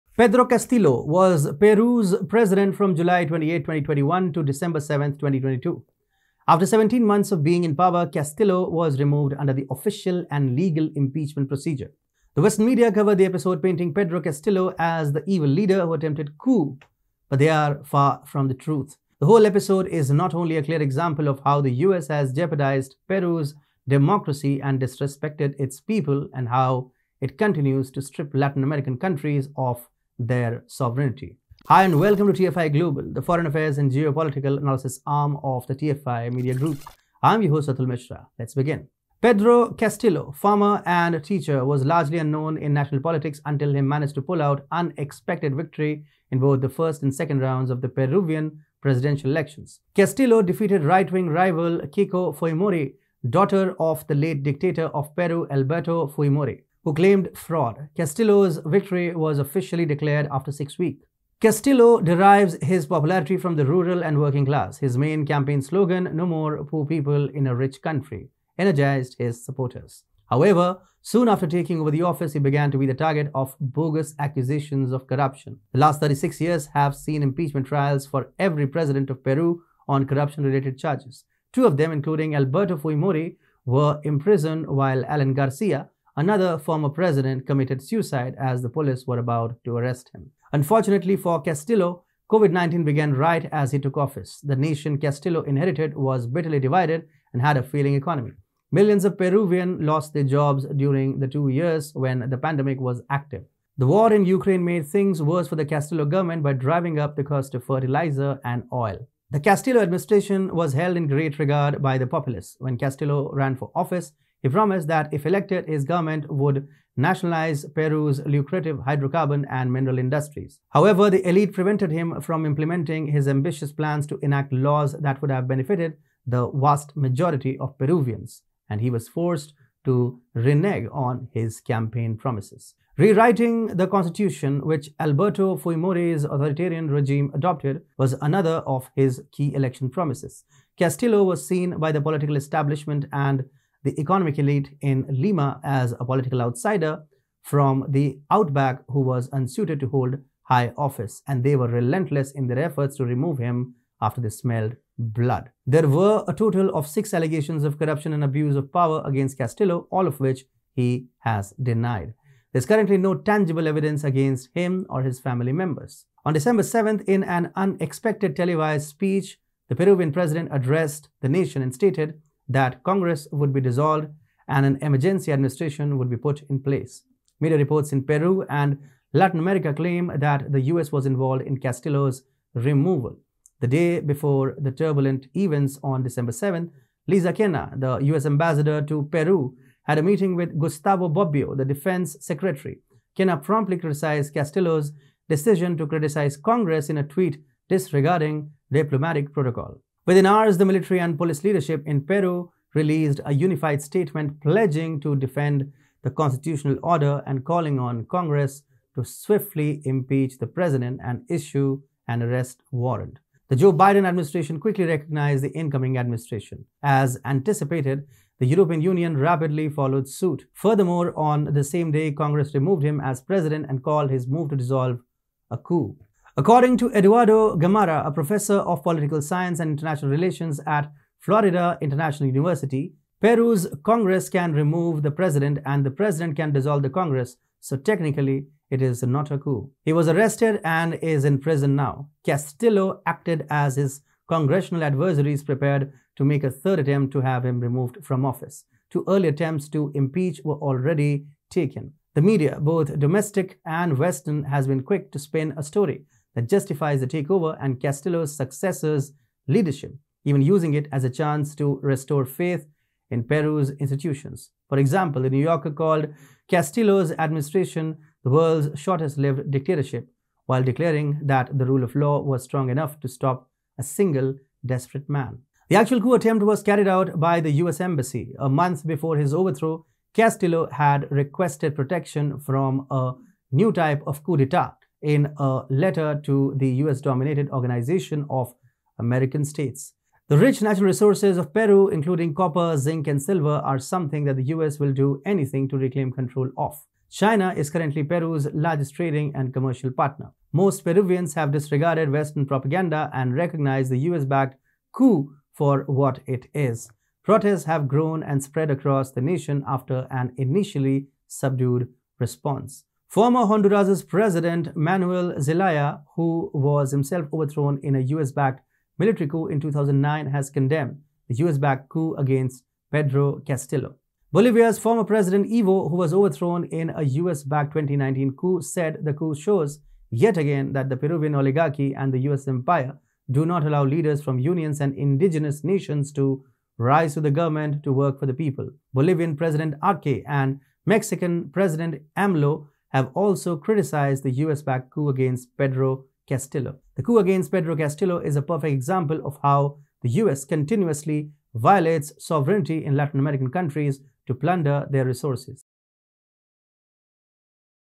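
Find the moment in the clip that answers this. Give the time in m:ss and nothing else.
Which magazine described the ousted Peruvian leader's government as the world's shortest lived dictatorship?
4:25.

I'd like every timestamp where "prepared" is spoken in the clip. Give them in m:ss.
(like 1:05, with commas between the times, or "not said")
4:05.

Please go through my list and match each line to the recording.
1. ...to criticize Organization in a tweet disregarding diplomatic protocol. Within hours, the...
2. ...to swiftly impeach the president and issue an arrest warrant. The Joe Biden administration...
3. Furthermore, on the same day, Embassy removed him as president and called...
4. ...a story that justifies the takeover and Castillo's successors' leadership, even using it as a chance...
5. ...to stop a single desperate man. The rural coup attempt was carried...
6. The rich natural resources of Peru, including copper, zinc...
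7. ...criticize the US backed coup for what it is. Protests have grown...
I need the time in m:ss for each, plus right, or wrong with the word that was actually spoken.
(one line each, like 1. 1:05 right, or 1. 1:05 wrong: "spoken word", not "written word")
1. 3:15 wrong: "Congress", not "Organization"
2. 3:28 right
3. 3:40 wrong: "Congress", not "Embassy"
4. 4:15 right
5. 4:33 wrong: "actual", not "rural"
6. 4:50 right
7. 5:03 wrong: "recognize", not "criticize".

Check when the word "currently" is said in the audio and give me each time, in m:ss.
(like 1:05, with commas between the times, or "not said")
2:42, 4:57.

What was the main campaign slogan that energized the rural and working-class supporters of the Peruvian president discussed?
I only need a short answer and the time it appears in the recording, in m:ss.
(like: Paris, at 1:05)
No More Poor People in a Rich Country, at 1:06.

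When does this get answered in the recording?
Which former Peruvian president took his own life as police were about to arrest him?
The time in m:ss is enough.
1:25.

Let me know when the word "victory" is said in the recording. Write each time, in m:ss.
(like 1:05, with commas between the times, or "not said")
0:45, 0:58.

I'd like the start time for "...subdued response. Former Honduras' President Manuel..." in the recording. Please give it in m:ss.
5:11.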